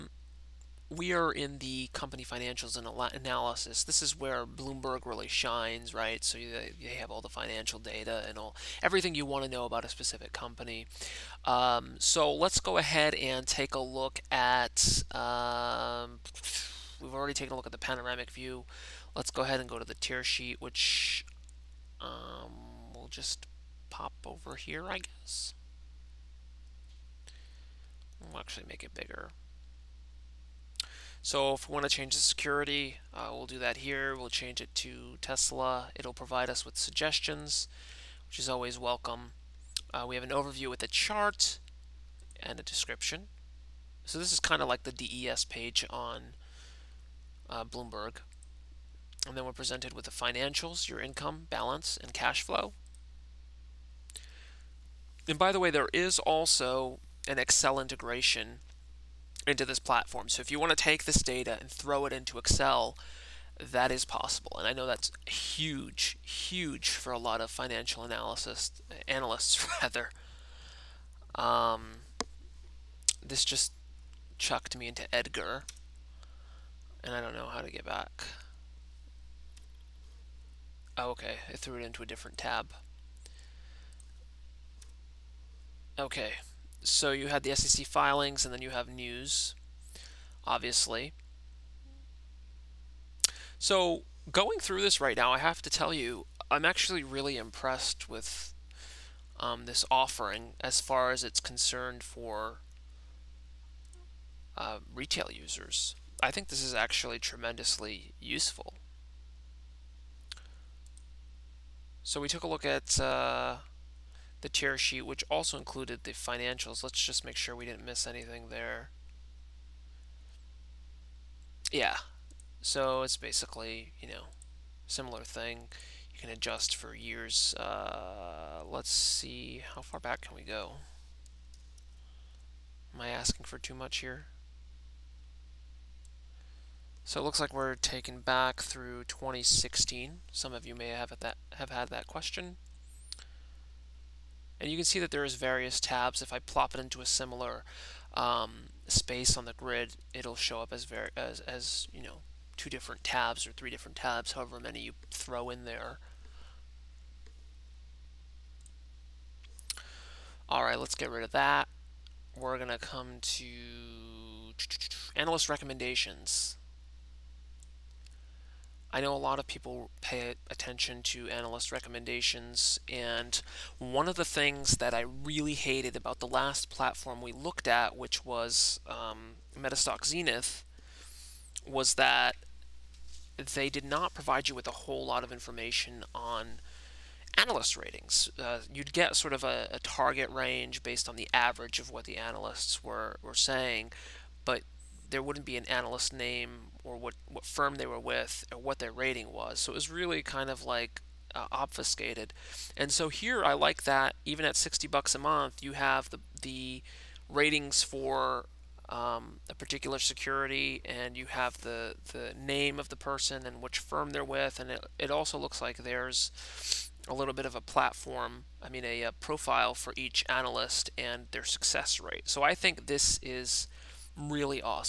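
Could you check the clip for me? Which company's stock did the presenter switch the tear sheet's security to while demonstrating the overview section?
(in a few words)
Tesla.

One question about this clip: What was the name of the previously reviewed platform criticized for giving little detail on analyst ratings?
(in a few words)
MetaStock Xenith.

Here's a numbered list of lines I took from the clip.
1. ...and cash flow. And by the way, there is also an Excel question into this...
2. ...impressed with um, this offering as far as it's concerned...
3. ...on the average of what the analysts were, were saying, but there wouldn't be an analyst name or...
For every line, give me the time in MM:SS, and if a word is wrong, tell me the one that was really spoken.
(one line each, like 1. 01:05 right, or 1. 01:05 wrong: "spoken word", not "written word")
1. 00:52 wrong: "integration", not "question"
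2. 01:37 right
3. 03:11 right.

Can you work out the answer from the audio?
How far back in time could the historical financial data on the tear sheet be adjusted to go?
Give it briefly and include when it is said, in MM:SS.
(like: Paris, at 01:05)
2016, at 02:19.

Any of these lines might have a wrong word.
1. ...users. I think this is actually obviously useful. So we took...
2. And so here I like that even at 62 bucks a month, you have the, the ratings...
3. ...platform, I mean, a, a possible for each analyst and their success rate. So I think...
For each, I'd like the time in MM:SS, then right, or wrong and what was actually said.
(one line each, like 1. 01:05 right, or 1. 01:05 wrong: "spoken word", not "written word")
1. 01:45 wrong: "tremendously", not "obviously"
2. 03:22 wrong: "60", not "62"
3. 03:37 wrong: "profile", not "possible".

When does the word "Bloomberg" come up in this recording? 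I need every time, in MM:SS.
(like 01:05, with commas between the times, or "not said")
00:04, 00:47.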